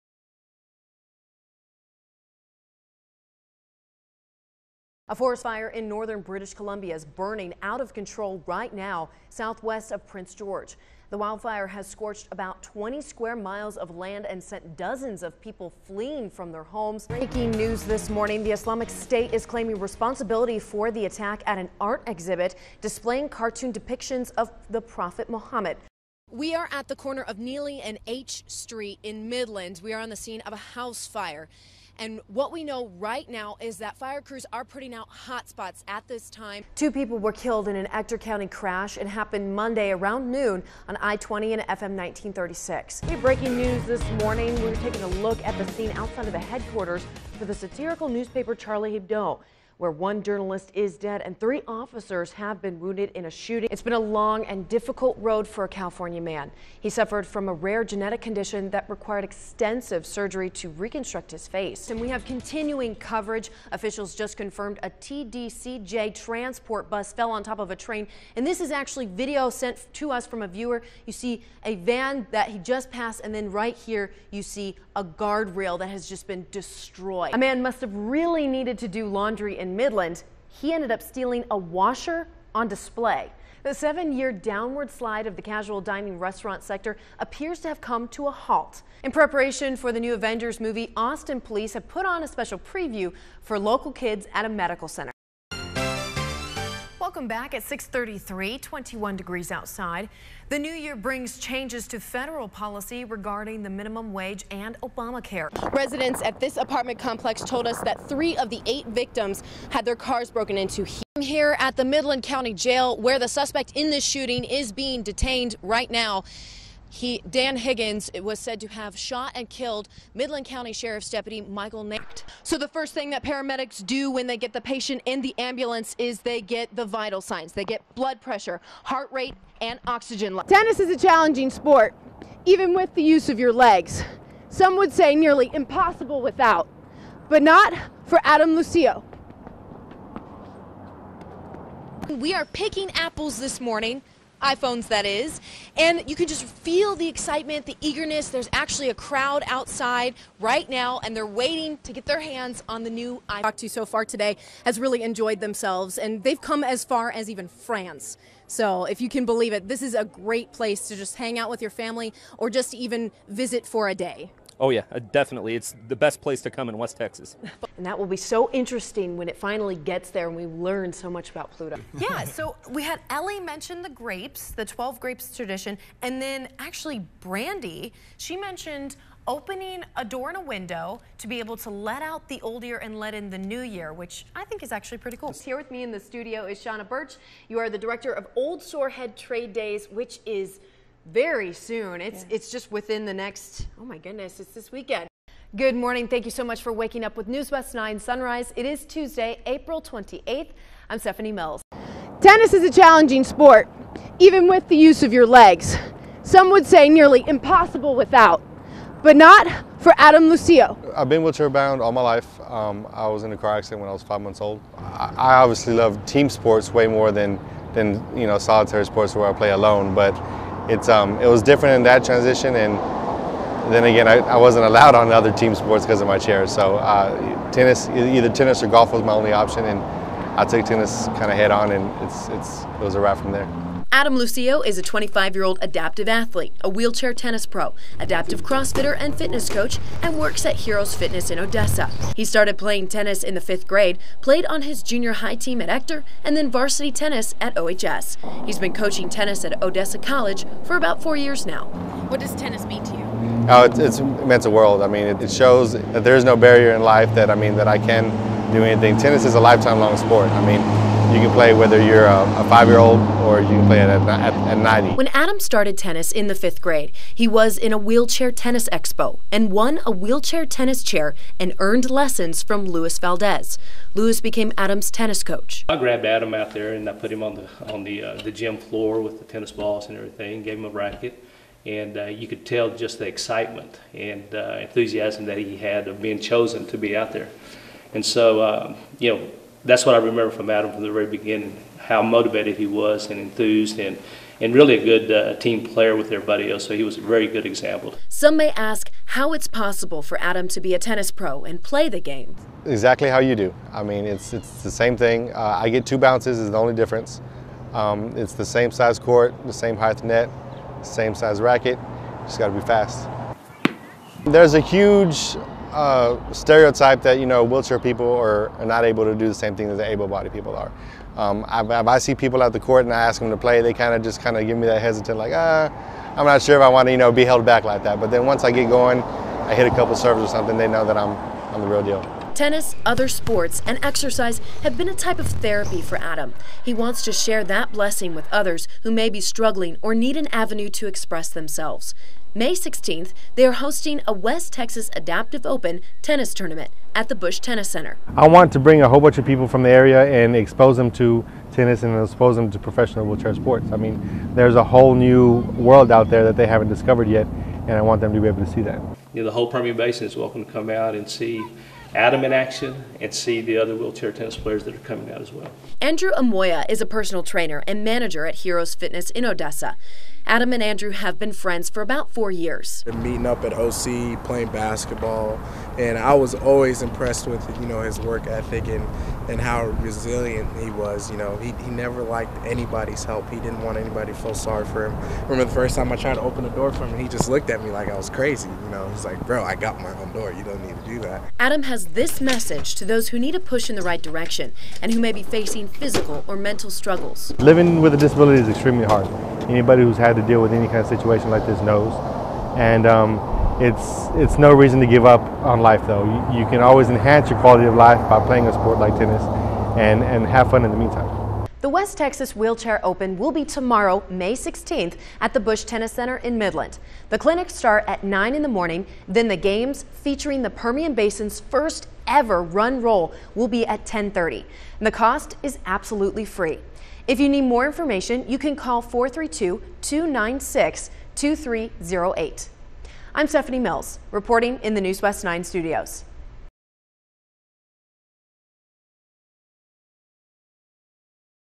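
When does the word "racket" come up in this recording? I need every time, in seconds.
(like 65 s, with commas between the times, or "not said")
280 s, 311 s.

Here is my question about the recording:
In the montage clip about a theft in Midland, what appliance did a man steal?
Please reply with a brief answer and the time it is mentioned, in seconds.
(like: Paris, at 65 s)
a washer, at 81 s.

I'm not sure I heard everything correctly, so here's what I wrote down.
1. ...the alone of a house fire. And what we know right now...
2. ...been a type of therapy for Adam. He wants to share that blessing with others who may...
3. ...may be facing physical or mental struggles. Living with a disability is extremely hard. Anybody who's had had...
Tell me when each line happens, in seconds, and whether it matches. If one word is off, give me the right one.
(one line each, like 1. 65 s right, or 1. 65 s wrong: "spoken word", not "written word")
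1. 30 s wrong: "scene", not "alone"
2. 334 s right
3. 394 s right.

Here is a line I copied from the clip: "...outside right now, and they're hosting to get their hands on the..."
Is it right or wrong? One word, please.
wrong.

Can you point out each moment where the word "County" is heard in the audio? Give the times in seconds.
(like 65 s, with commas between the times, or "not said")
38 s, 112 s, 120 s.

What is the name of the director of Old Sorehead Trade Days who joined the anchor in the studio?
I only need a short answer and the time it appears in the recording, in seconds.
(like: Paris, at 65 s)
Shauna Birch, at 186 s.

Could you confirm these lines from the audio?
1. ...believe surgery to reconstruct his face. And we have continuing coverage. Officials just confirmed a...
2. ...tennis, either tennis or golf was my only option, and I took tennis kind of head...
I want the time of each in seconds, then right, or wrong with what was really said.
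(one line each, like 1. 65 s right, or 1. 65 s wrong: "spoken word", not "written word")
1. 59 s wrong: "extensive", not "believe"
2. 227 s right.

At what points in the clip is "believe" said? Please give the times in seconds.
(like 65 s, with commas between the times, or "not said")
159 s.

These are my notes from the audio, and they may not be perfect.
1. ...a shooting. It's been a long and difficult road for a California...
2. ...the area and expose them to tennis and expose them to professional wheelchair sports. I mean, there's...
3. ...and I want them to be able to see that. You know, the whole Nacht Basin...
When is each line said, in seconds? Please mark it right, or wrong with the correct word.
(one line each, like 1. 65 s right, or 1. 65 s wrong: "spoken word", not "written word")
1. 53 s right
2. 349 s right
3. 357 s wrong: "Permian", not "Nacht".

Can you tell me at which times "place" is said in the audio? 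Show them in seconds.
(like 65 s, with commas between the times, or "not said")
160 s, 166 s.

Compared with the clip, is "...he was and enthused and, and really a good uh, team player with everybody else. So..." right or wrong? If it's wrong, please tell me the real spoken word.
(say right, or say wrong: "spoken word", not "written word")
right.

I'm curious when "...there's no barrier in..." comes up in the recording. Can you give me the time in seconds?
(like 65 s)
256 s.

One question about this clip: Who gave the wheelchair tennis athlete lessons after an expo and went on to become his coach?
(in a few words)
Luis Valdez.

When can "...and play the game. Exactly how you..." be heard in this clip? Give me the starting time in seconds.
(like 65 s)
301 s.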